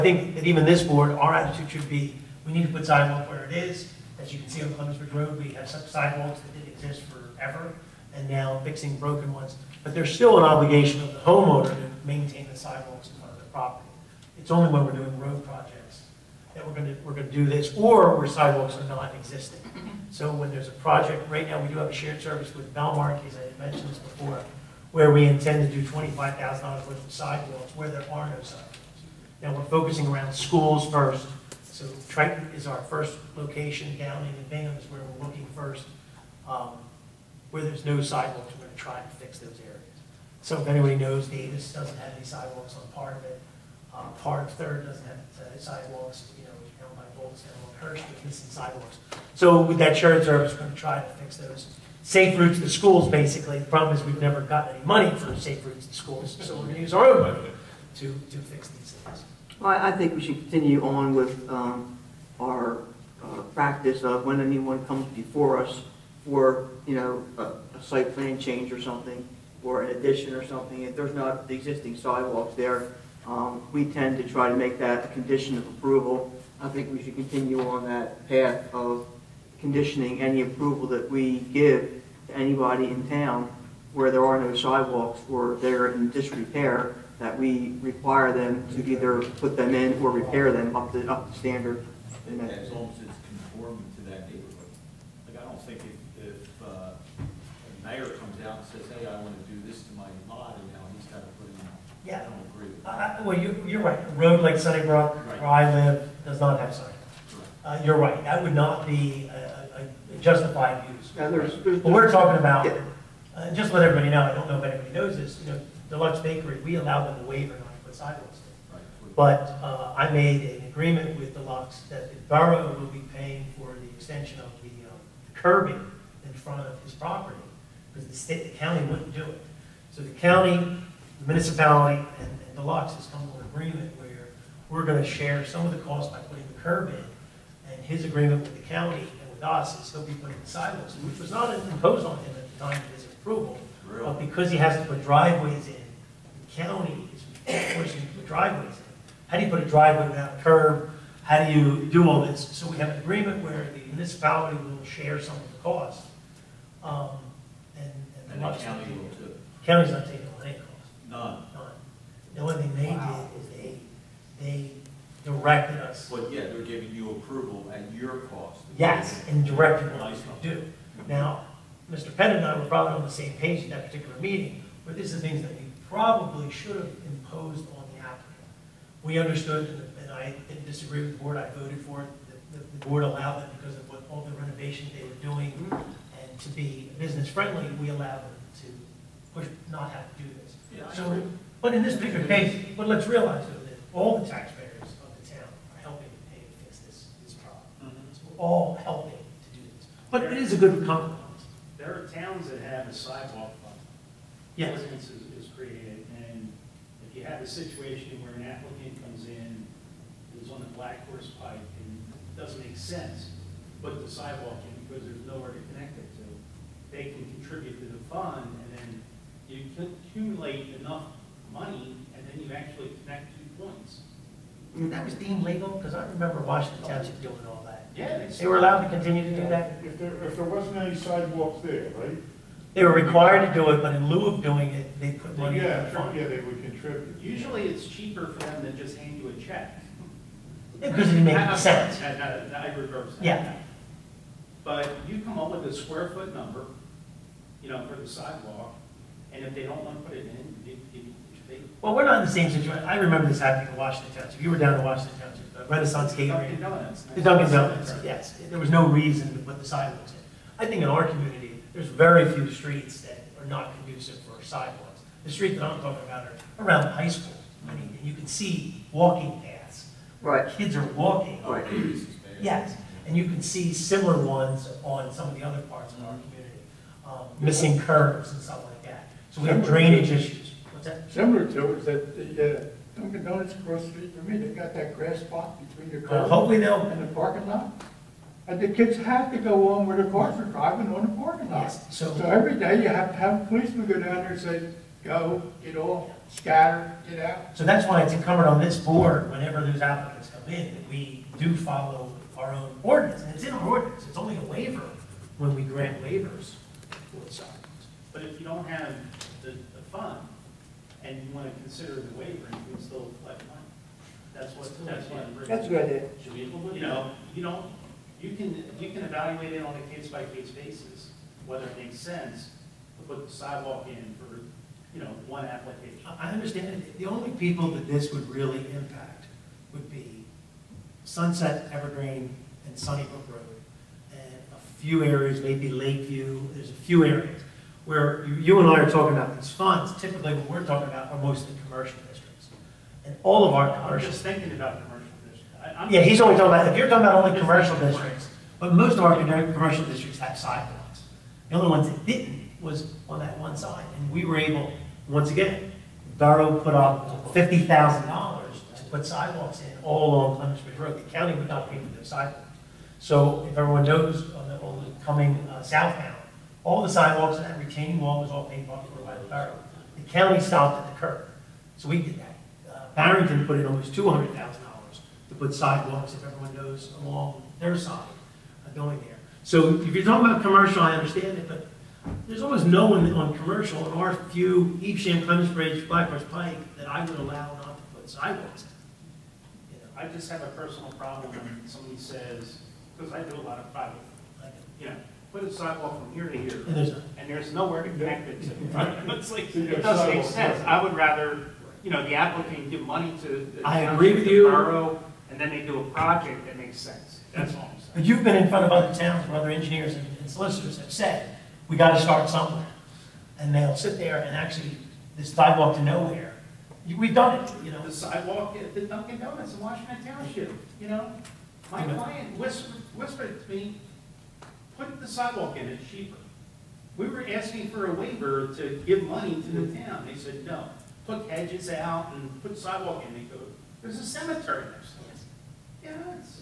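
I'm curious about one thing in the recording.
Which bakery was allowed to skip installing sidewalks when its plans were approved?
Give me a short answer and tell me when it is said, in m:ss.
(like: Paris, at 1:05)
Deluxe Bakery, at 1:55.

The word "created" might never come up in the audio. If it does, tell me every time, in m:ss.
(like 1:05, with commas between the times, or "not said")
3:25.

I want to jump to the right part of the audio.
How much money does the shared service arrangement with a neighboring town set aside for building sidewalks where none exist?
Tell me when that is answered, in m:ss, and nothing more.
0:25.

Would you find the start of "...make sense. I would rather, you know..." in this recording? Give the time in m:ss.
6:40.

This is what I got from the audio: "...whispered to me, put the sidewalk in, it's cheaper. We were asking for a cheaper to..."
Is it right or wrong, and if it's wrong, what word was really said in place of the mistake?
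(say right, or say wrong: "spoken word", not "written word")
wrong: "waiver", not "cheaper".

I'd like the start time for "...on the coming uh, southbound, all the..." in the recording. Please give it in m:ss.
6:04.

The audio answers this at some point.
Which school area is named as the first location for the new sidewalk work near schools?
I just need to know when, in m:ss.
0:32.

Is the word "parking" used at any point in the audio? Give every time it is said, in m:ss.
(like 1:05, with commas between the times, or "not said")
4:47, 4:51.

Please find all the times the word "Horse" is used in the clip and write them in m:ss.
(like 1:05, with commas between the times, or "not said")
3:31, 6:26.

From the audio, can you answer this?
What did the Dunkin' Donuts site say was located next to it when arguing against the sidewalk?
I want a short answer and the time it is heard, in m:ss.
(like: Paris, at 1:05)
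a cemetery, at 7:14.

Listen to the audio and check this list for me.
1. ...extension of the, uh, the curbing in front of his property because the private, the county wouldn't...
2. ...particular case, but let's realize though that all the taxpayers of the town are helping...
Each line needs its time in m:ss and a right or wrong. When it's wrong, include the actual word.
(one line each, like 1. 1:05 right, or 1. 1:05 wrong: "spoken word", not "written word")
1. 2:03 wrong: "state", not "private"
2. 3:11 right.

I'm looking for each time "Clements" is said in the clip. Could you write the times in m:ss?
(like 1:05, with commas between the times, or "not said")
0:04, 6:00, 6:25.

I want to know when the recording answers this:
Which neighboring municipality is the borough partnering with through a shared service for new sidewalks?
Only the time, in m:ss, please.
0:22.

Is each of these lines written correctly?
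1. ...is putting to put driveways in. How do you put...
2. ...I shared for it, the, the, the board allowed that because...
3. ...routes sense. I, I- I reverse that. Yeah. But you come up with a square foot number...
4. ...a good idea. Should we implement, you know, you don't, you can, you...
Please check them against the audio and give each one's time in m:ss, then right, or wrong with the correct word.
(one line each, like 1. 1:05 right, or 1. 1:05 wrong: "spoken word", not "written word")
1. 2:27 wrong: "pushing", not "putting"
2. 3:01 wrong: "voted", not "shared"
3. 4:01 wrong: "makes", not "routes"
4. 5:15 right.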